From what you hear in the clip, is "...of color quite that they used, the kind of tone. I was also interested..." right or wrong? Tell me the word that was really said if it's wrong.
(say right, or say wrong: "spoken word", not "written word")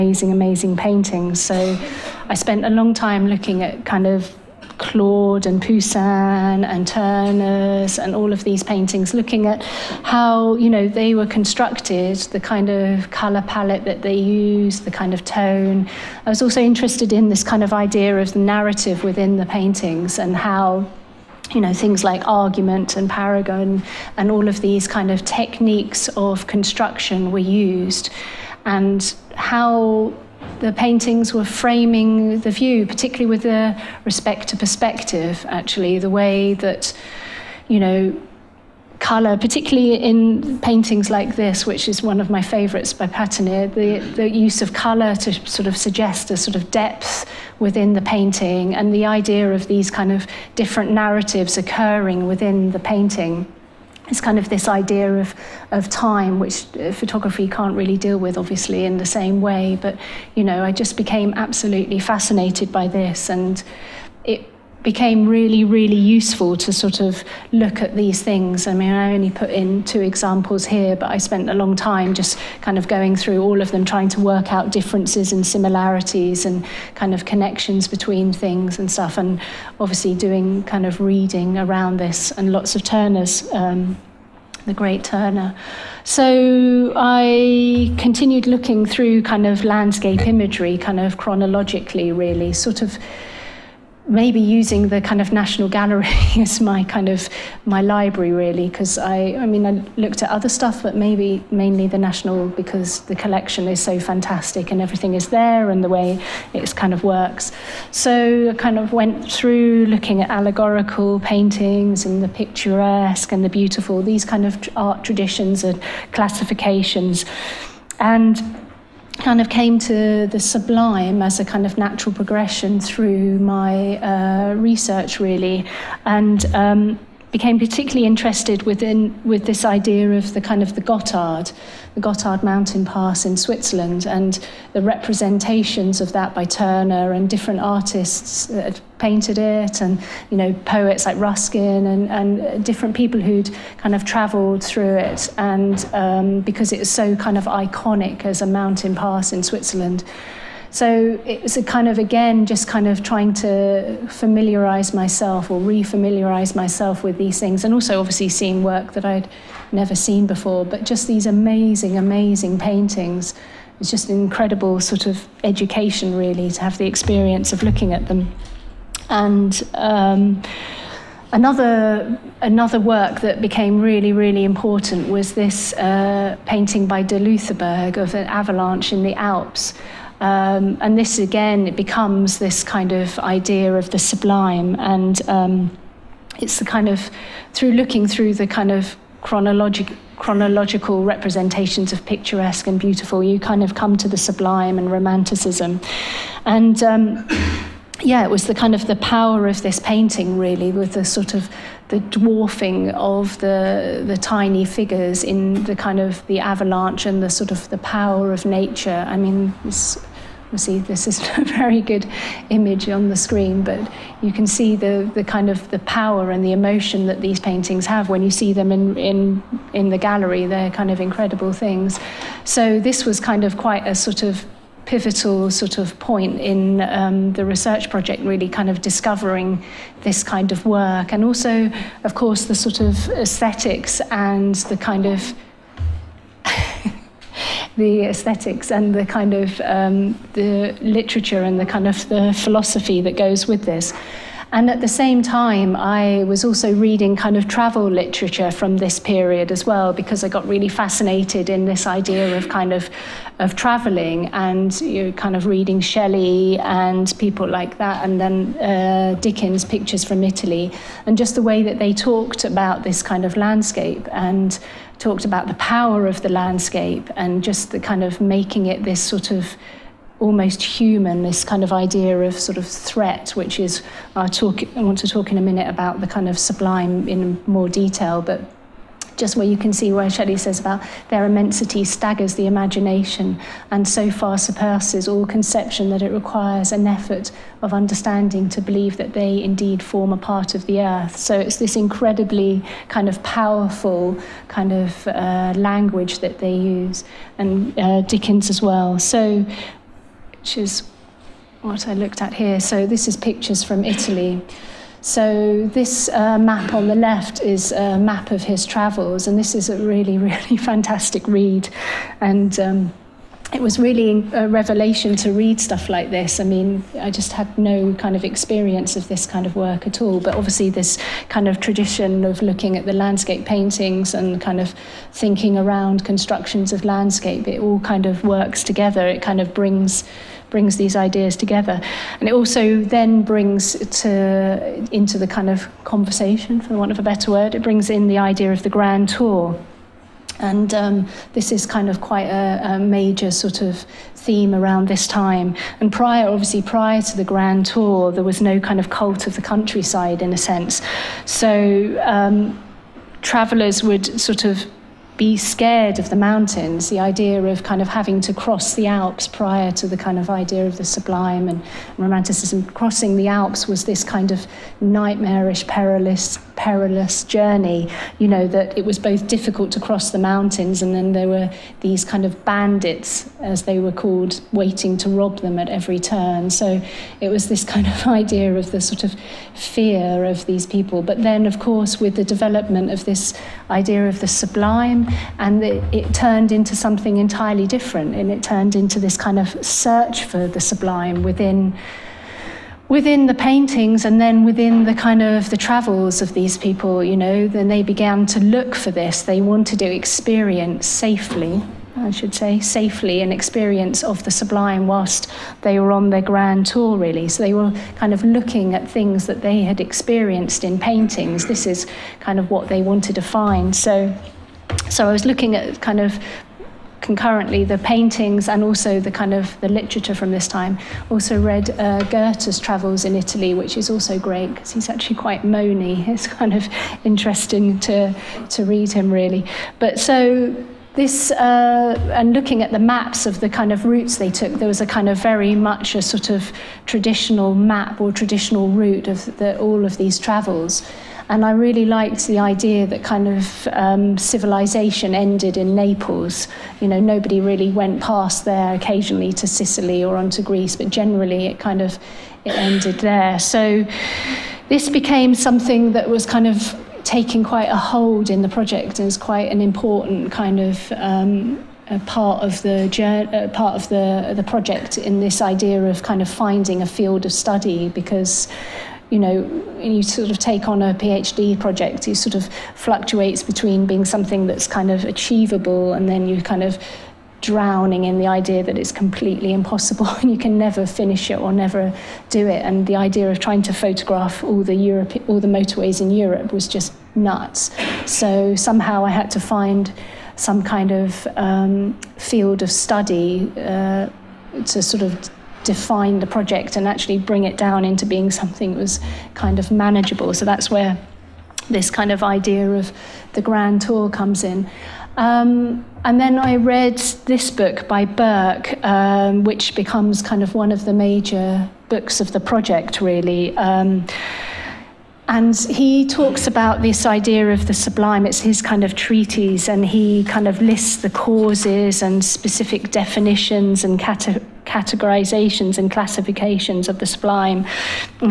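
wrong: "palette", not "quite".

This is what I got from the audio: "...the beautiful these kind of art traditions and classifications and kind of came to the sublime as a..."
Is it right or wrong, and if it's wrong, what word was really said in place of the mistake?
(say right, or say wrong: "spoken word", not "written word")
right.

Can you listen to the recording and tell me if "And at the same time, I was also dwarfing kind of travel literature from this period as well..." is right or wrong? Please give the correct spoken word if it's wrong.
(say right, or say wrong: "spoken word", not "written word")
wrong: "reading", not "dwarfing".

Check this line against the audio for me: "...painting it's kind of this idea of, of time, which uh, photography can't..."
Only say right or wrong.
right.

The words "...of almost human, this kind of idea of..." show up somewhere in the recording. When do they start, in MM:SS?
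04:29.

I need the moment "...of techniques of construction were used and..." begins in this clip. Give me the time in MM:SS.
00:25.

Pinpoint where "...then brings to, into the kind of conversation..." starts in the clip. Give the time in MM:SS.
05:32.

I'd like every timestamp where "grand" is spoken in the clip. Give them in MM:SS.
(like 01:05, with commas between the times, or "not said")
05:38, 05:47, 06:46, 08:23.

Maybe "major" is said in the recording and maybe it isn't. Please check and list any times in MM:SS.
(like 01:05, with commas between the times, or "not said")
05:42, 08:30.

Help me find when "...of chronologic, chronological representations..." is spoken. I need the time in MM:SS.
03:08.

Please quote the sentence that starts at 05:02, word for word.
So this is pictures from Italy.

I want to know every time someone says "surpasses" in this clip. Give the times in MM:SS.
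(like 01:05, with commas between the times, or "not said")
04:44.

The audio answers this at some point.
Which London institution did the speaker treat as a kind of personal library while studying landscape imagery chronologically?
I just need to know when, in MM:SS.
01:35.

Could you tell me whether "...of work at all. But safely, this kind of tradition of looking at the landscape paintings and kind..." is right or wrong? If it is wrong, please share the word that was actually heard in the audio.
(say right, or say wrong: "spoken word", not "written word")
wrong: "obviously", not "safely".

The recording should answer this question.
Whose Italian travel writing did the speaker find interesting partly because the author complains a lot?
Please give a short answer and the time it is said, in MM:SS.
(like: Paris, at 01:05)
Goethe, at 07:02.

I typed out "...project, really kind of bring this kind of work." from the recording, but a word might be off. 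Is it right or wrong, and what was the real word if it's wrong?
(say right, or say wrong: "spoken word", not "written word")
wrong: "discovering", not "bring".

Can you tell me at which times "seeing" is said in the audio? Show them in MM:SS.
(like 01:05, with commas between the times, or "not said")
02:38.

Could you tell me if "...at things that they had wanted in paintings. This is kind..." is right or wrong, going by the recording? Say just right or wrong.
wrong.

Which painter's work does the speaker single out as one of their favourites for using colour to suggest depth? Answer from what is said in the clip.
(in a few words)
Patinir.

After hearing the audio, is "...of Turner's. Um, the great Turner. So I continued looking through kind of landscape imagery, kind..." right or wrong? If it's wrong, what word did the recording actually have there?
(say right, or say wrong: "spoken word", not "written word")
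right.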